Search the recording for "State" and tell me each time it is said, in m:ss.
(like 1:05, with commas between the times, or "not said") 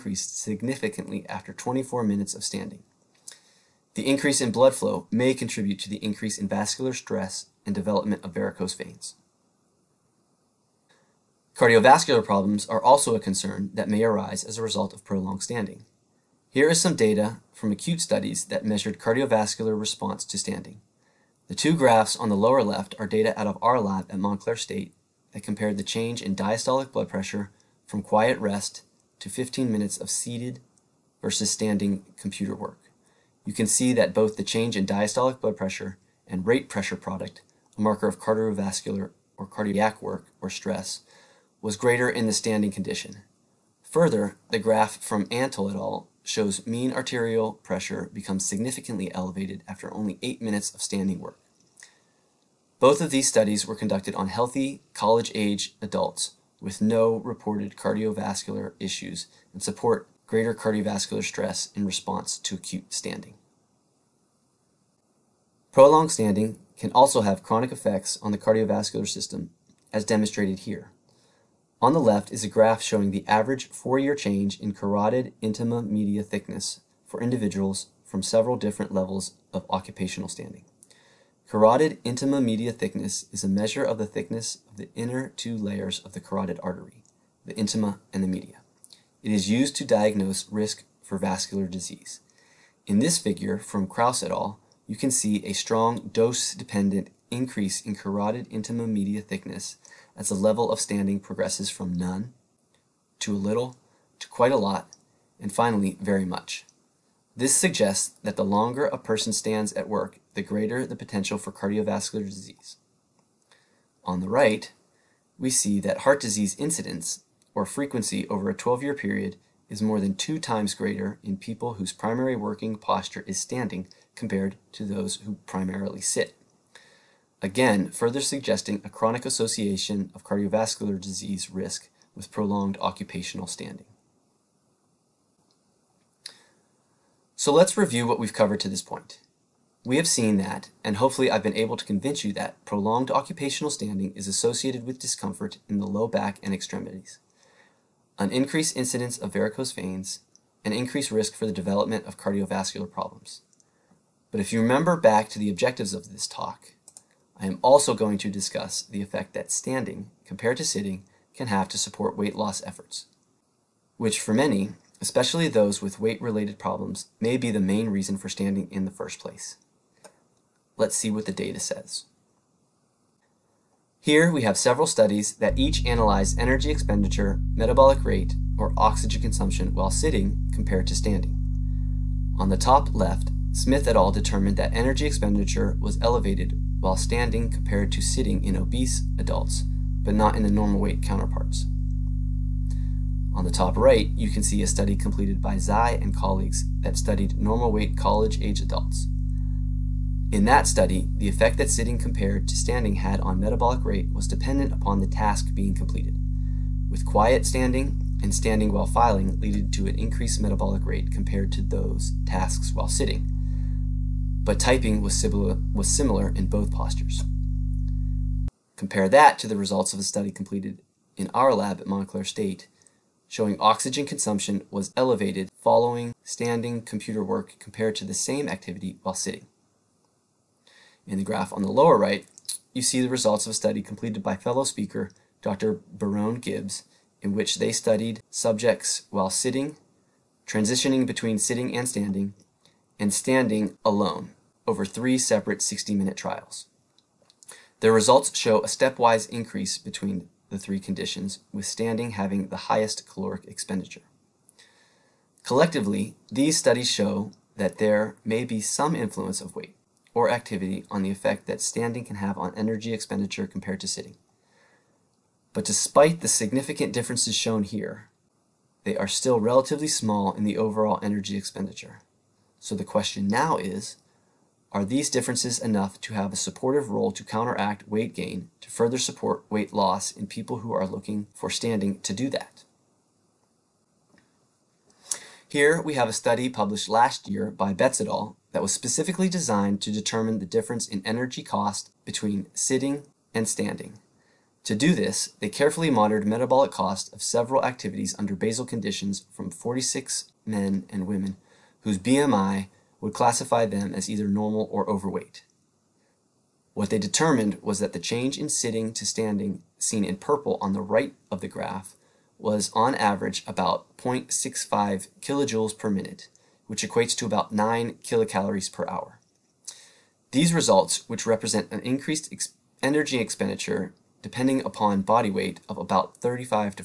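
0:24, 3:42.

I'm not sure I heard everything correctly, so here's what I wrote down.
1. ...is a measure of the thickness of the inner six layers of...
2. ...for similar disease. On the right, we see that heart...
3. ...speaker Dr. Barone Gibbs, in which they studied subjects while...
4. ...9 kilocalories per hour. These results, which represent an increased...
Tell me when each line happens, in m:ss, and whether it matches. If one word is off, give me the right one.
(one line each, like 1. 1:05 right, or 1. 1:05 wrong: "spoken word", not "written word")
1. 1:23 wrong: "two", not "six"
2. 1:51 wrong: "cardiovascular", not "similar"
3. 3:54 right
4. 5:17 right.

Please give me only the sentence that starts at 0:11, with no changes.
Cardiovascular problems are also a concern that may arise as a result of prolonged standing.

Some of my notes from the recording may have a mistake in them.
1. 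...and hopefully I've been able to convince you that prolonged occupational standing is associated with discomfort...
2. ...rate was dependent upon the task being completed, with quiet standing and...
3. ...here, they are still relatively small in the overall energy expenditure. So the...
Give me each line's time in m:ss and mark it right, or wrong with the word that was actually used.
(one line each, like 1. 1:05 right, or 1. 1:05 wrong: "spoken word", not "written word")
1. 2:20 right
2. 3:23 right
3. 4:27 right.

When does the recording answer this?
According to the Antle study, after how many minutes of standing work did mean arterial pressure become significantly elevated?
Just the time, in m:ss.
0:50.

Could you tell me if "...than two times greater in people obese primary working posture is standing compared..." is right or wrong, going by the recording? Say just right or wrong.
wrong.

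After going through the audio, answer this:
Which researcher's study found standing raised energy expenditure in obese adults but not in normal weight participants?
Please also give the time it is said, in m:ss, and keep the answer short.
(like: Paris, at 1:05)
Smith, at 3:03.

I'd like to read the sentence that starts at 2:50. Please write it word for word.
Let's see what the data says.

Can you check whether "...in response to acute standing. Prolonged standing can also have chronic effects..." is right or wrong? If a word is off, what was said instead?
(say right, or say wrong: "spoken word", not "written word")
right.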